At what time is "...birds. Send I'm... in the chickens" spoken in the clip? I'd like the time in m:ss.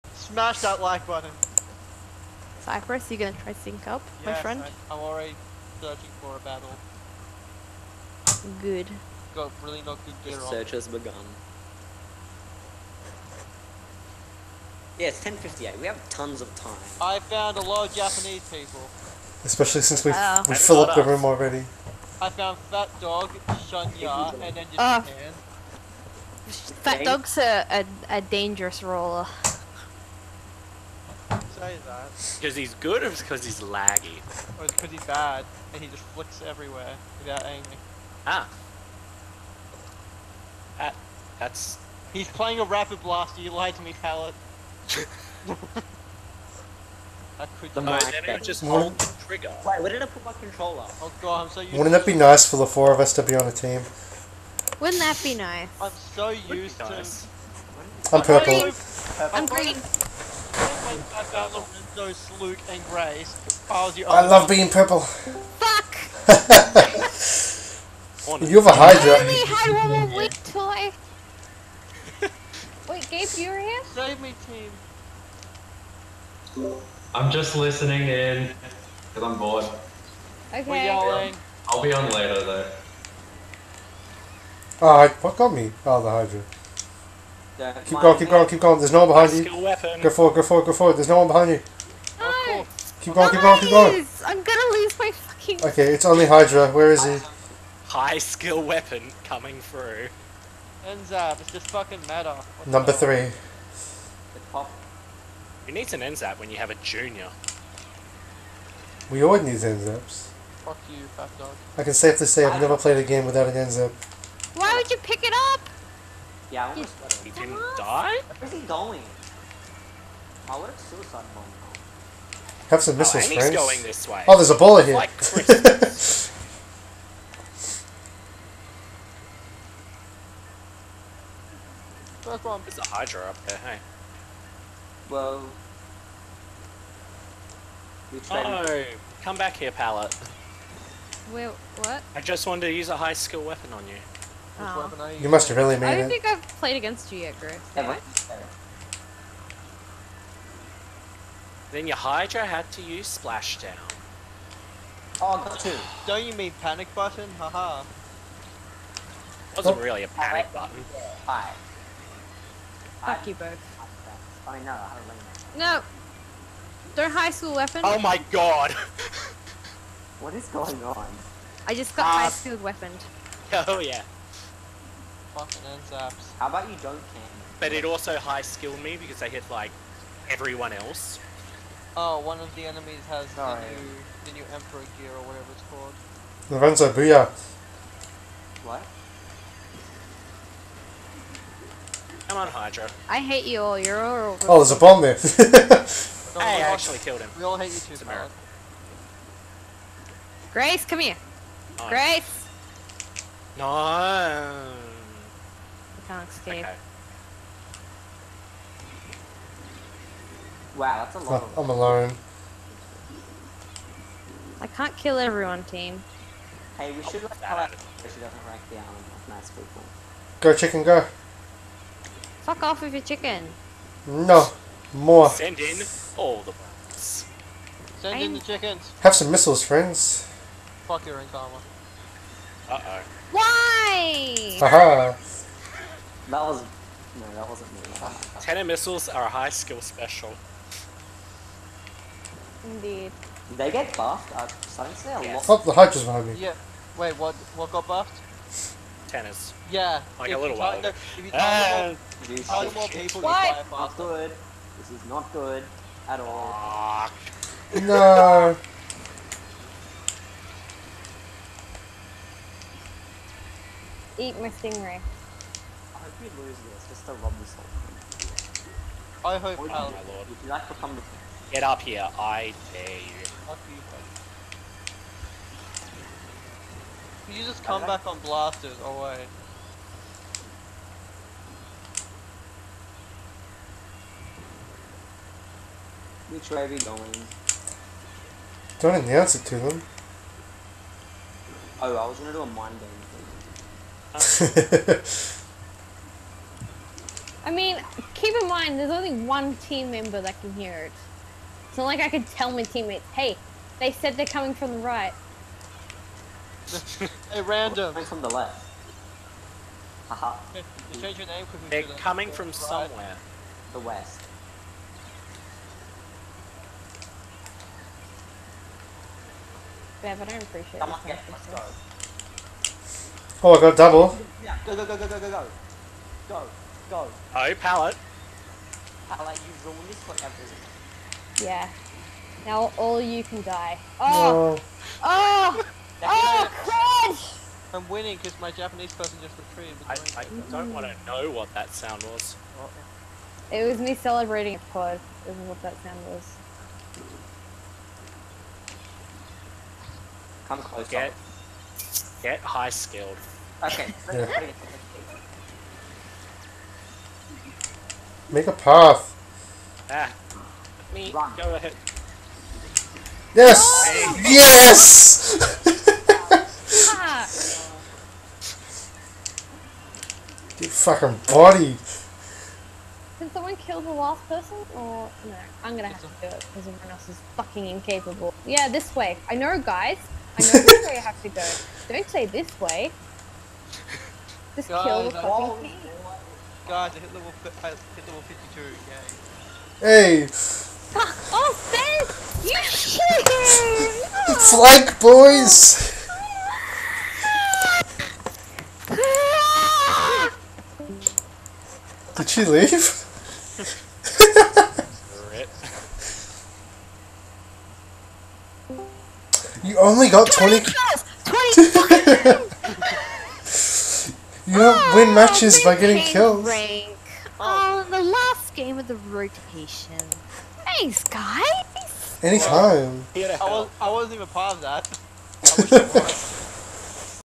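3:46.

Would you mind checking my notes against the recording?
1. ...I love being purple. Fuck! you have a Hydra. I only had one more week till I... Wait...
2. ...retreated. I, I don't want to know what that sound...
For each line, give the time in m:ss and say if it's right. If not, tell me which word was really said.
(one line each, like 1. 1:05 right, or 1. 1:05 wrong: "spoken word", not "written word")
1. 1:04 right
2. 5:39 right.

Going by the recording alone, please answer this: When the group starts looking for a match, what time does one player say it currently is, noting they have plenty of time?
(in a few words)
10.58.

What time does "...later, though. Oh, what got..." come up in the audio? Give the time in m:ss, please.
1:22.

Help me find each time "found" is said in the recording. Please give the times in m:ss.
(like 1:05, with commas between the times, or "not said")
0:17, 0:22.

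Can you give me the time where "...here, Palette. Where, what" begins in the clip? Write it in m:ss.
2:19.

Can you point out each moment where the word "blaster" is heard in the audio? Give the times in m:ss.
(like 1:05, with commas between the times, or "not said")
0:43, 4:38.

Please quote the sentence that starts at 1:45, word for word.
You need an N-ZAP when you have a junior?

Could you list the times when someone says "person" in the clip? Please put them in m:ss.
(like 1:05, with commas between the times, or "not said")
5:38, 6:14.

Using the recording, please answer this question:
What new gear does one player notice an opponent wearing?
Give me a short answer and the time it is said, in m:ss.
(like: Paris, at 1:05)
Emperor gear, at 3:04.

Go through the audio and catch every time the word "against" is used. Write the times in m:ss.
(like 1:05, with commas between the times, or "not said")
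2:26.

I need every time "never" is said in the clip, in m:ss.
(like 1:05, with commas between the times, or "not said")
1:52.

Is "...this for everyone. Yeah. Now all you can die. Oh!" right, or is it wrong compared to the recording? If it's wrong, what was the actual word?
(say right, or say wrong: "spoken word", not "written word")
right.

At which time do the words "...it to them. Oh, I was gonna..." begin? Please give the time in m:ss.
4:49.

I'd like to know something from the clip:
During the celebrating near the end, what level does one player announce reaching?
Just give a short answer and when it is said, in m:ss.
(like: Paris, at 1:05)
52, at 6:28.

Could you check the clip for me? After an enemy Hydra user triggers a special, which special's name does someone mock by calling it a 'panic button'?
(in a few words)
Splashdown.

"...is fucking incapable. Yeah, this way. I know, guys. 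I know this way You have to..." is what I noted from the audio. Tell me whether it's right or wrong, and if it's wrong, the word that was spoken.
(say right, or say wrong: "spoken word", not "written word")
right.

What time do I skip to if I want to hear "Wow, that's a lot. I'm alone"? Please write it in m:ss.
3:30.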